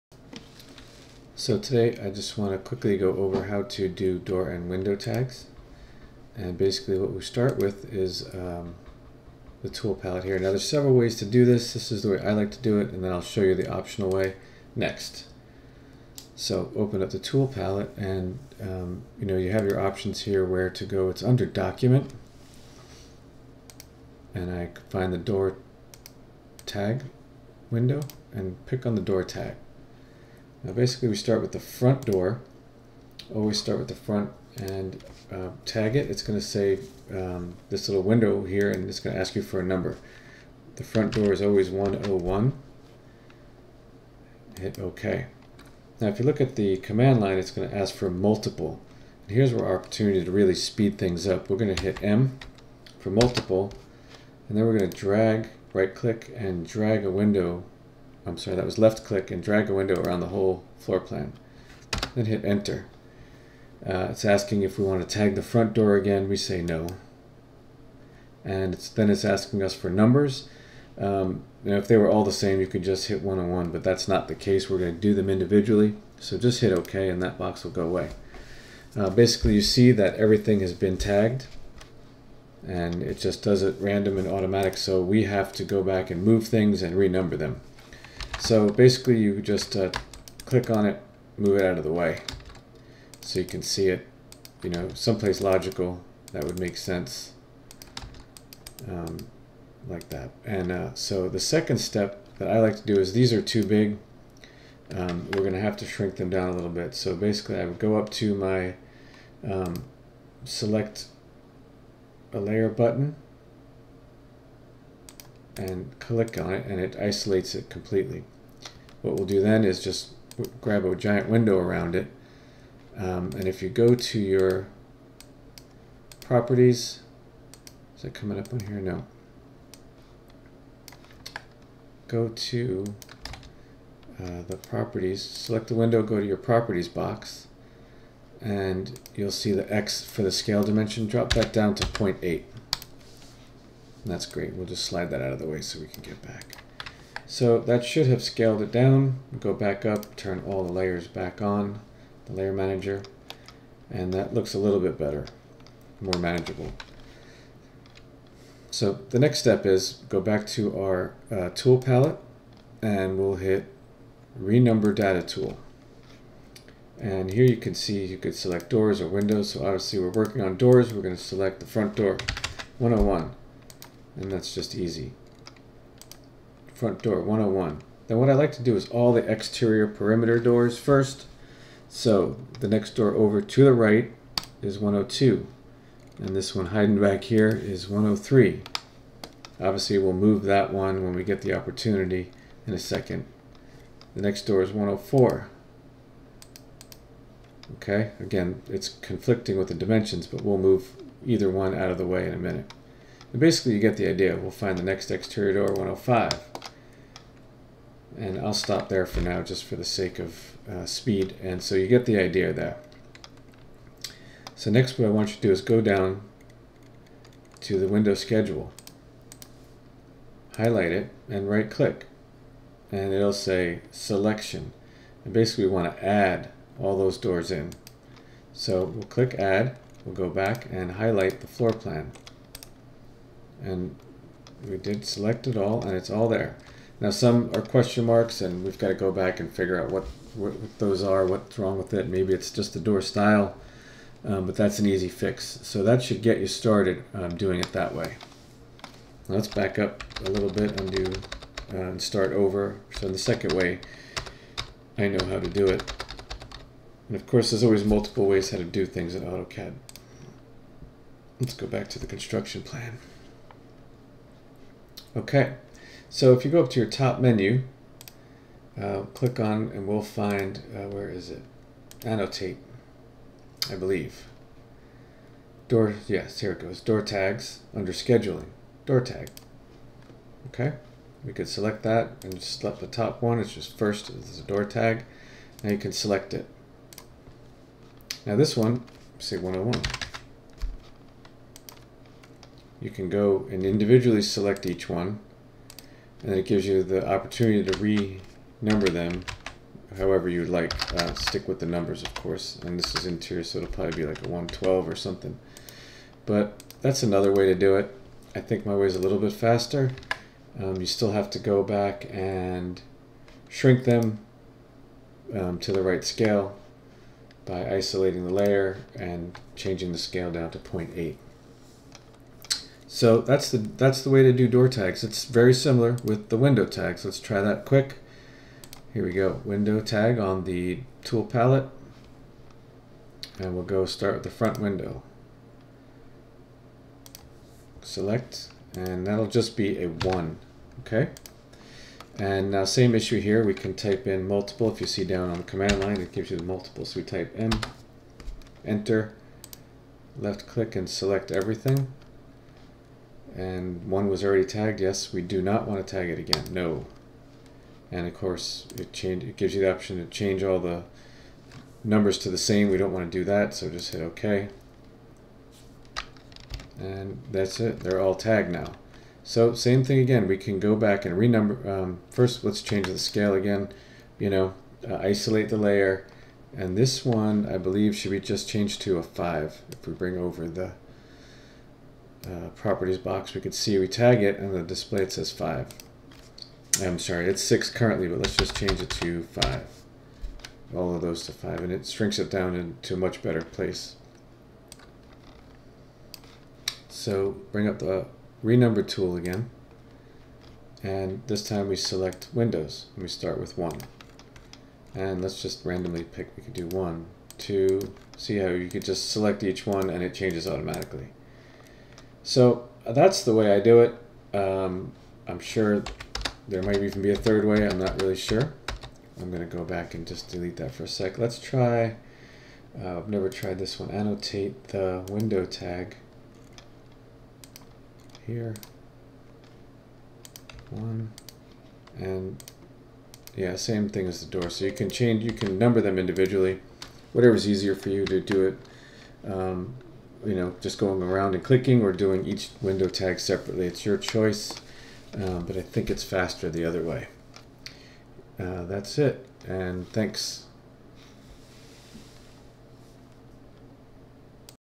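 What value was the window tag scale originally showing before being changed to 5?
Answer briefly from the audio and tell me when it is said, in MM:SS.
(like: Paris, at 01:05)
6, at 06:27.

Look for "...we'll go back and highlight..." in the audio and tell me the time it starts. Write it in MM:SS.
03:50.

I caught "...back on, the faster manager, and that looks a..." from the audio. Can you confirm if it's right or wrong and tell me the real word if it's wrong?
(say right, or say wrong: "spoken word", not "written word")
wrong: "layer", not "faster".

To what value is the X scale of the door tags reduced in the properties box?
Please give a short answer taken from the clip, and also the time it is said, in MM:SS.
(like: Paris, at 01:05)
0.8, at 02:21.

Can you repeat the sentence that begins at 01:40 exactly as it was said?
And uh, so the second step that I like to do is these are too big.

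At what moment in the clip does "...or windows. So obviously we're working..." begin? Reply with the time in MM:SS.
02:49.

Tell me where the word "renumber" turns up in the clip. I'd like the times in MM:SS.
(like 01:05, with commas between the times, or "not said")
01:26, 02:44, 04:57, 06:11, 06:38.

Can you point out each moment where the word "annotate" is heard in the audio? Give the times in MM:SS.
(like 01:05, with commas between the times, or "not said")
04:32, 07:03.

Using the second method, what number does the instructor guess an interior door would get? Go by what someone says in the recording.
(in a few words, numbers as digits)
112.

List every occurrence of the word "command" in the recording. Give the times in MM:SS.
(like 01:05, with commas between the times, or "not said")
00:46, 05:45.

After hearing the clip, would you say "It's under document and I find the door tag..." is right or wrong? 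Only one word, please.
right.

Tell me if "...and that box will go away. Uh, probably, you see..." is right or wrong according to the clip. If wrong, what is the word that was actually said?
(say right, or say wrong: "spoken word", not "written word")
wrong: "basically", not "probably".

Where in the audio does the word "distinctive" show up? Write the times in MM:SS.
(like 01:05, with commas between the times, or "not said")
not said.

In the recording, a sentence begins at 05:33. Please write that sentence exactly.
And we'll go start with the front window.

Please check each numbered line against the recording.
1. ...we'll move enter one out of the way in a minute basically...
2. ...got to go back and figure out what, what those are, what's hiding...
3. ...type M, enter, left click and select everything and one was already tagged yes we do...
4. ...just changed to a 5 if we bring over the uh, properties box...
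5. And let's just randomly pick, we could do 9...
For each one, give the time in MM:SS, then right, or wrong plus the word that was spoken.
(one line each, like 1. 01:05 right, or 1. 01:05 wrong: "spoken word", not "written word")
1. 03:20 wrong: "either", not "enter"
2. 03:58 wrong: "wrong", not "hiding"
3. 05:47 right
4. 06:18 right
5. 06:44 wrong: "1", not "9".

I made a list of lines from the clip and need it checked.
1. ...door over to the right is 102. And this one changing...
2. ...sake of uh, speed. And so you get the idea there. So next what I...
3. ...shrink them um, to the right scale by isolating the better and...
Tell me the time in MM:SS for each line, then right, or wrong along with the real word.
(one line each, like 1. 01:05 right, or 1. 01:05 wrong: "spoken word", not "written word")
1. 03:02 wrong: "hiding", not "changing"
2. 03:29 right
3. 05:13 wrong: "layer", not "better".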